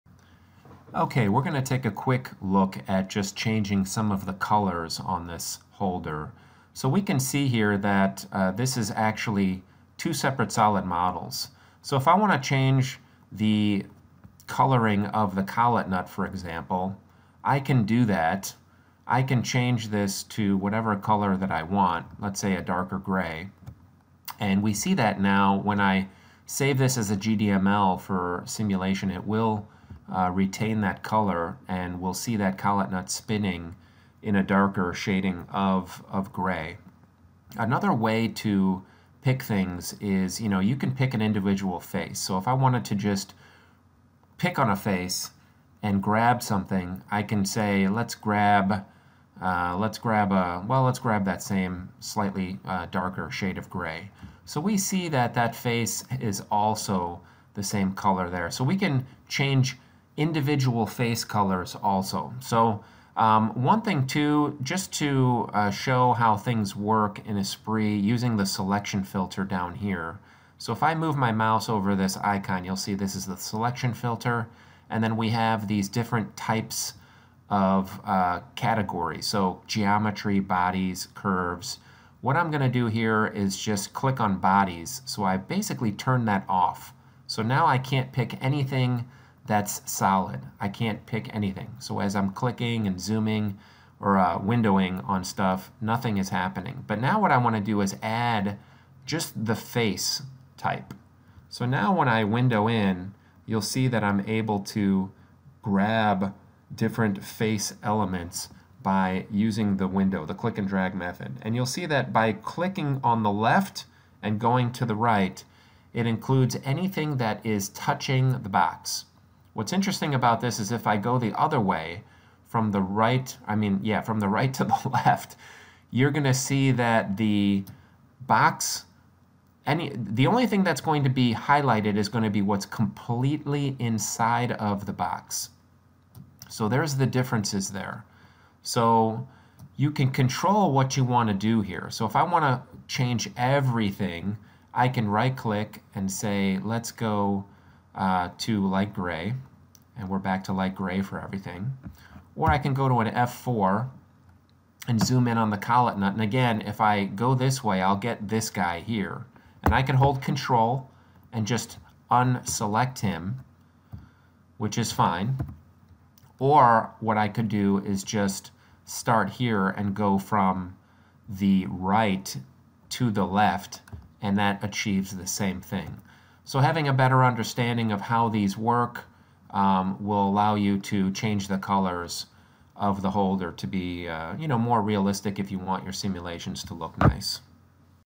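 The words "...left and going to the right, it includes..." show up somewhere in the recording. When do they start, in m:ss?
1:53.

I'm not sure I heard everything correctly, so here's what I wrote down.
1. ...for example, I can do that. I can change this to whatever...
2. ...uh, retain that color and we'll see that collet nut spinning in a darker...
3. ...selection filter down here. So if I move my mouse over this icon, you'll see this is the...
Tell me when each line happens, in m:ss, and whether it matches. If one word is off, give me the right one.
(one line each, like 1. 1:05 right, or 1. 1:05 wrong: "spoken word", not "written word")
1. 0:16 right
2. 0:30 right
3. 1:08 right.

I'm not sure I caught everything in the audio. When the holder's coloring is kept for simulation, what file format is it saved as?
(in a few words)
GDML.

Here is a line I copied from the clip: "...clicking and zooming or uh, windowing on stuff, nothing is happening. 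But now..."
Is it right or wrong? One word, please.
right.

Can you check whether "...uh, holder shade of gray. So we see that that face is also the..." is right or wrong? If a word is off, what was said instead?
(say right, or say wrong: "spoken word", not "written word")
wrong: "darker", not "holder".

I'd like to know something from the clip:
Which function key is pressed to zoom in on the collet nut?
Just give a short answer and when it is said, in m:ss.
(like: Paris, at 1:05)
F4, at 2:33.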